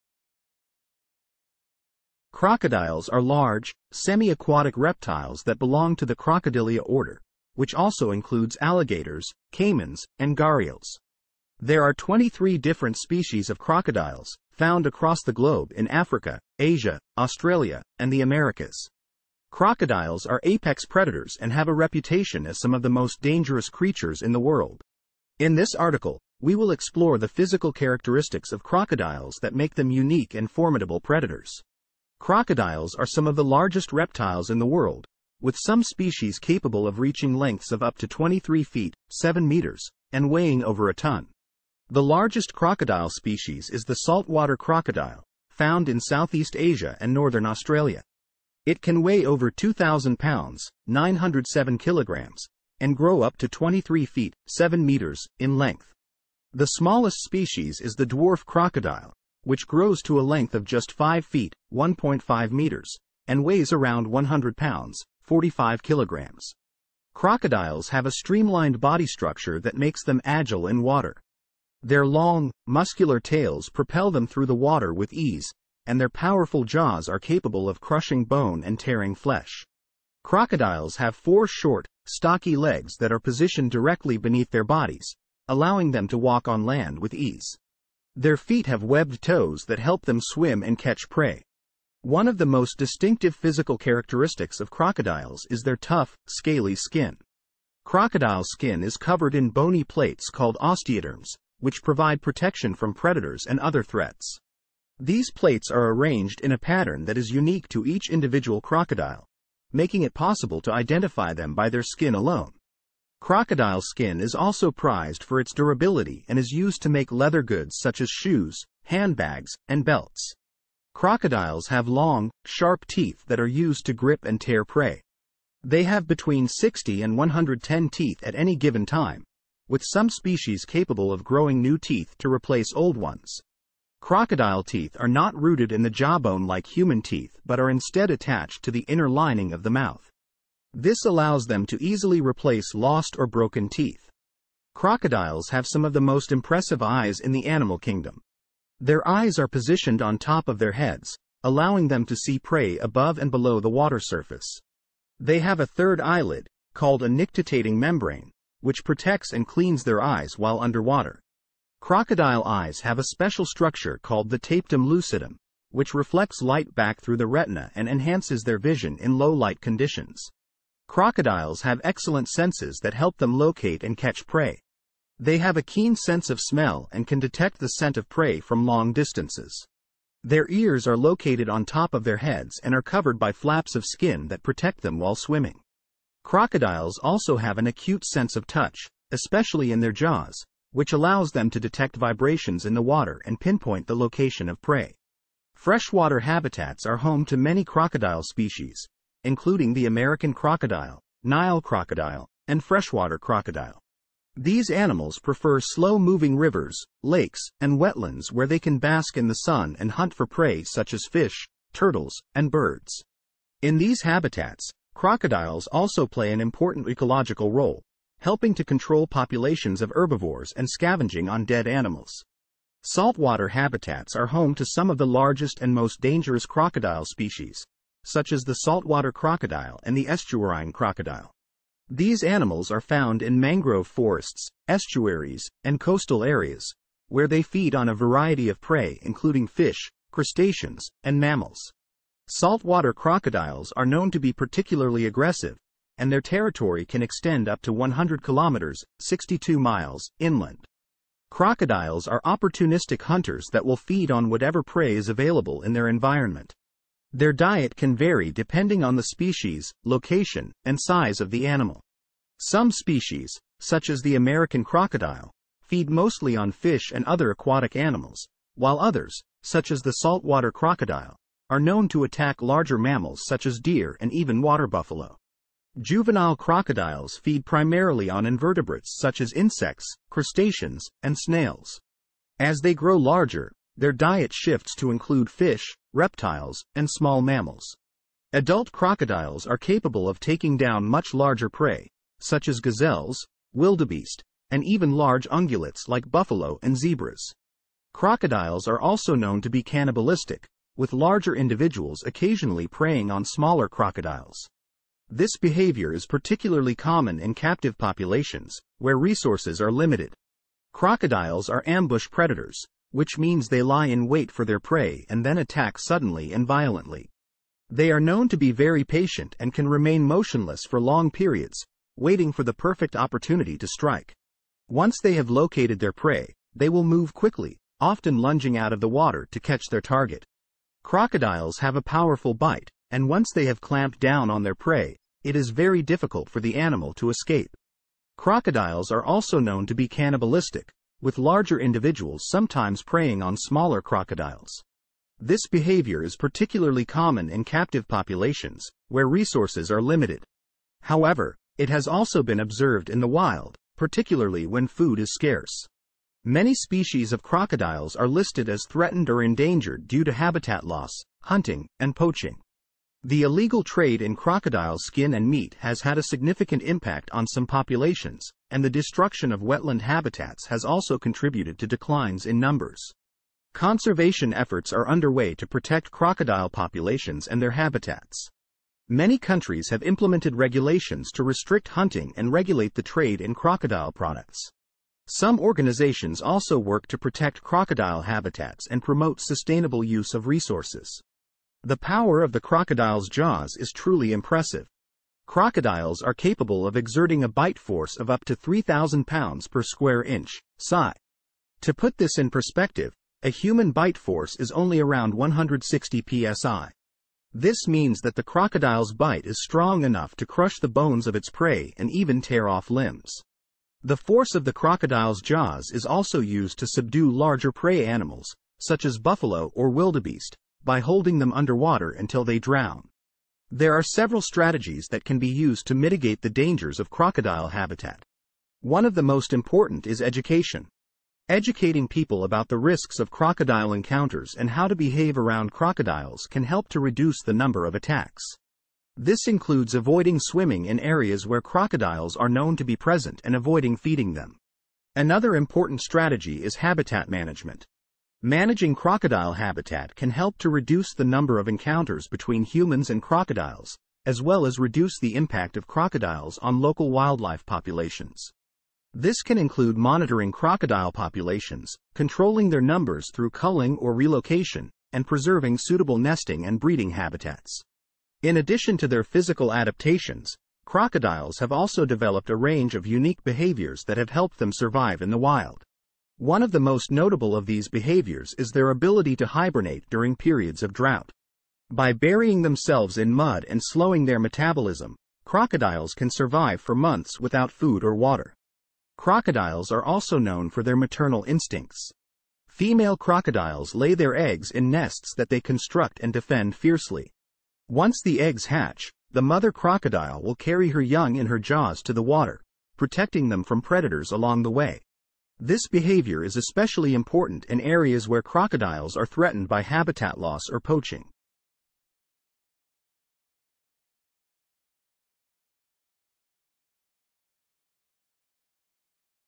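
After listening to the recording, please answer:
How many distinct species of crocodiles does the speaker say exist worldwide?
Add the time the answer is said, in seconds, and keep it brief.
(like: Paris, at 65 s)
23, at 11 s.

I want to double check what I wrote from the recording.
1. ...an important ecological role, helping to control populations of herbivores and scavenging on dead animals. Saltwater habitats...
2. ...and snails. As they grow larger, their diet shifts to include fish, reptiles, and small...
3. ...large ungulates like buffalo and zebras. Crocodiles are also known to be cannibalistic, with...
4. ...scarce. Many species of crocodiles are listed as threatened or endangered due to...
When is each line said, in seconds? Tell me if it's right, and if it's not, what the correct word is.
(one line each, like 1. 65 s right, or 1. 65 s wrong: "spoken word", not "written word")
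1. 216 s right
2. 281 s right
3. 294 s right
4. 355 s right.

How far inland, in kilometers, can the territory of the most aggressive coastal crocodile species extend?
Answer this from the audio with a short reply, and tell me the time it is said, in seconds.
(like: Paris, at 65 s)
100 kilometers, at 247 s.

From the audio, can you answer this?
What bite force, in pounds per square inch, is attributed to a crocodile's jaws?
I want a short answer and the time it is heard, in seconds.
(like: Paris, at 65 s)
3,000 psi, at 398 s.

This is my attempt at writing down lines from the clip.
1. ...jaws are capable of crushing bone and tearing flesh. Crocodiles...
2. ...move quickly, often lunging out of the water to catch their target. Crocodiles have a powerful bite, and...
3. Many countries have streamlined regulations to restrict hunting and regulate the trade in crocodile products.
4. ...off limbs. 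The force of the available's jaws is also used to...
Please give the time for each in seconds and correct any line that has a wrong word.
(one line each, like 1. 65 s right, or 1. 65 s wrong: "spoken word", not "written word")
1. 76 s right
2. 326 s right
3. 378 s wrong: "implemented", not "streamlined"
4. 412 s wrong: "crocodile", not "available".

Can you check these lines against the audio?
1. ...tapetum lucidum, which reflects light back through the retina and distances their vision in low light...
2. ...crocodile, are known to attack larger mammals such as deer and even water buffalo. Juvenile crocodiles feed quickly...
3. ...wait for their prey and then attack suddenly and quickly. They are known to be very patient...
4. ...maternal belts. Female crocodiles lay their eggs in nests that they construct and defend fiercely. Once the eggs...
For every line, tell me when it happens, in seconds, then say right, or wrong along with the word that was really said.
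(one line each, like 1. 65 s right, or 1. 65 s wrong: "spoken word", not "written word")
1. 164 s wrong: "enhances", not "distances"
2. 270 s wrong: "primarily", not "quickly"
3. 314 s wrong: "violently", not "quickly"
4. 490 s wrong: "instincts", not "belts".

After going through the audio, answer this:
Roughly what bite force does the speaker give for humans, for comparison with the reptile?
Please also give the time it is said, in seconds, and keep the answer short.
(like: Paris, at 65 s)
160 psi, at 405 s.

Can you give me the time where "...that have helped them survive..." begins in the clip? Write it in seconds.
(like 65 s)
473 s.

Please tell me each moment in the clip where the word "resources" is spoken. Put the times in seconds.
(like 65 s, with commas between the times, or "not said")
308 s, 349 s, 390 s.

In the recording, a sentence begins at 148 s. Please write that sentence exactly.
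Their eyes are positioned on top of their heads, allowing them to see prey above and below the water surface.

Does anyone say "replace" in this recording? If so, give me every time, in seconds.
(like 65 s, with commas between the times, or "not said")
132 s, 142 s.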